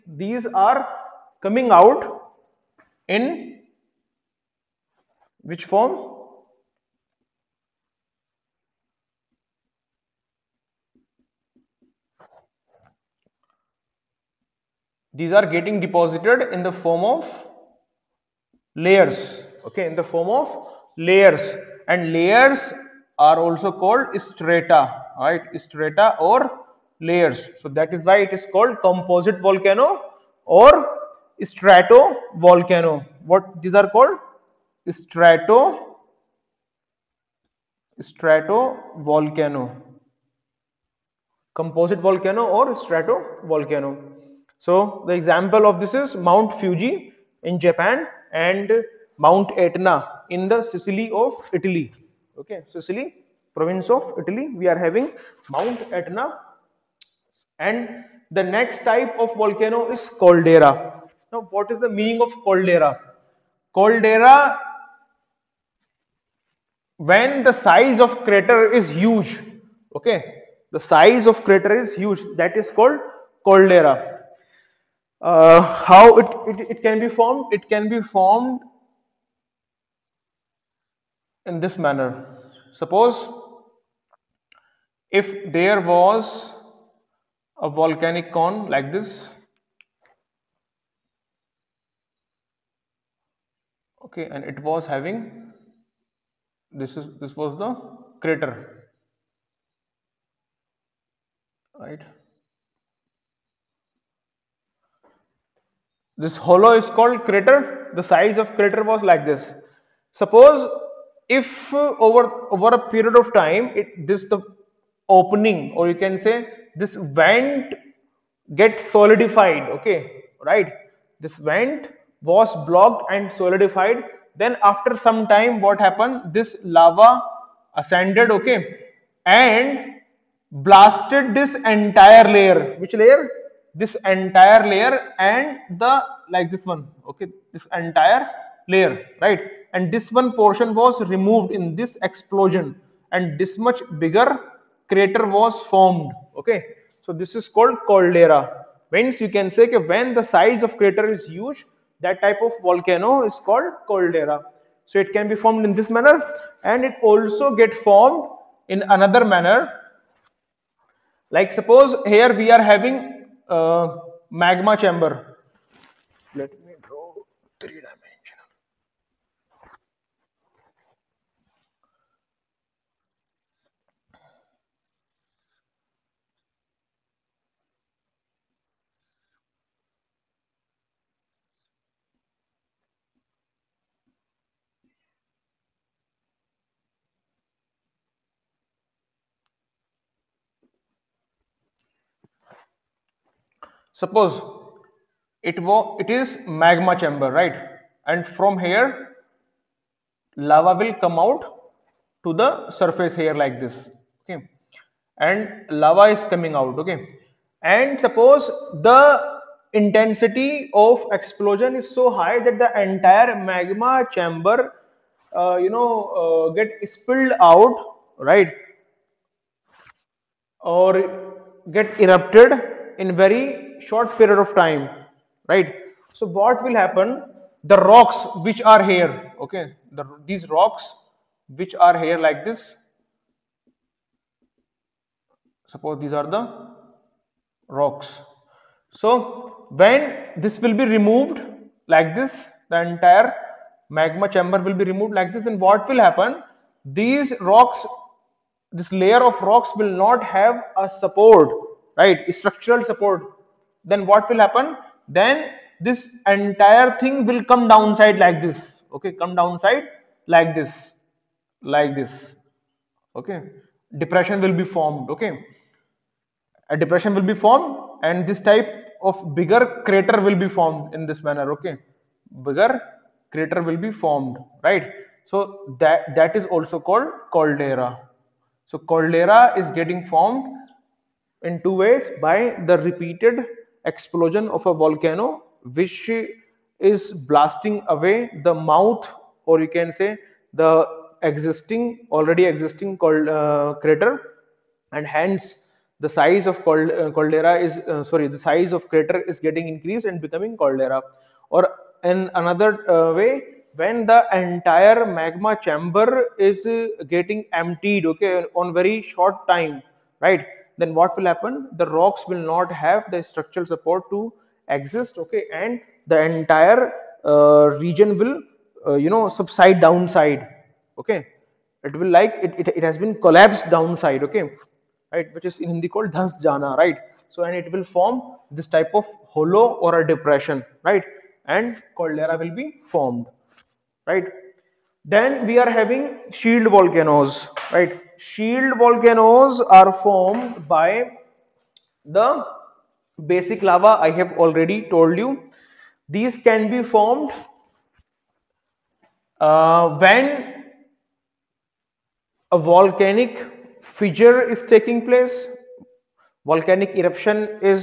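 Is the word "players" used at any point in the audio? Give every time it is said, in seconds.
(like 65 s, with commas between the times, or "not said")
not said.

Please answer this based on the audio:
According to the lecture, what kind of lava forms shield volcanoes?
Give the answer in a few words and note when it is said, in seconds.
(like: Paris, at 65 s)
Basic lava, at 343 s.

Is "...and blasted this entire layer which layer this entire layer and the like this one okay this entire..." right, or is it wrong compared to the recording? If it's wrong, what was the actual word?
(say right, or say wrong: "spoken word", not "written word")
right.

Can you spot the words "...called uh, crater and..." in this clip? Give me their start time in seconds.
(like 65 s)
292 s.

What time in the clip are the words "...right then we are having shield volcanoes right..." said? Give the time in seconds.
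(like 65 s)
334 s.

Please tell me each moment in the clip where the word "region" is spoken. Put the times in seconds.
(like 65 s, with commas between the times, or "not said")
317 s.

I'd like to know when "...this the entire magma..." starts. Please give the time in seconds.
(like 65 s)
242 s.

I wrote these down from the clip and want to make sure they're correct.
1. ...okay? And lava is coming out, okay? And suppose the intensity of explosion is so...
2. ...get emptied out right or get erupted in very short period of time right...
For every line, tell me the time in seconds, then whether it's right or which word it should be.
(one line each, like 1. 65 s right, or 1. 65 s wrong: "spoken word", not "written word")
1. 204 s right
2. 216 s wrong: "spilled", not "emptied".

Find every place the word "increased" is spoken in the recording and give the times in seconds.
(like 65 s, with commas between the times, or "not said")
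299 s.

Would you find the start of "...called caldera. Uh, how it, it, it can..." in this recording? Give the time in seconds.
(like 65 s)
72 s.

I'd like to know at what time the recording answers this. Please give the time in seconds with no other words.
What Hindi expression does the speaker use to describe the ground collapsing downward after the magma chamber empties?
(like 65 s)
326 s.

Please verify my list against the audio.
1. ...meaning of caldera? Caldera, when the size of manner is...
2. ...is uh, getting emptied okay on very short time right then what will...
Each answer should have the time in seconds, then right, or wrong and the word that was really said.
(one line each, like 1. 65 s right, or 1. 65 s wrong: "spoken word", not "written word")
1. 61 s wrong: "crater", not "manner"
2. 306 s right.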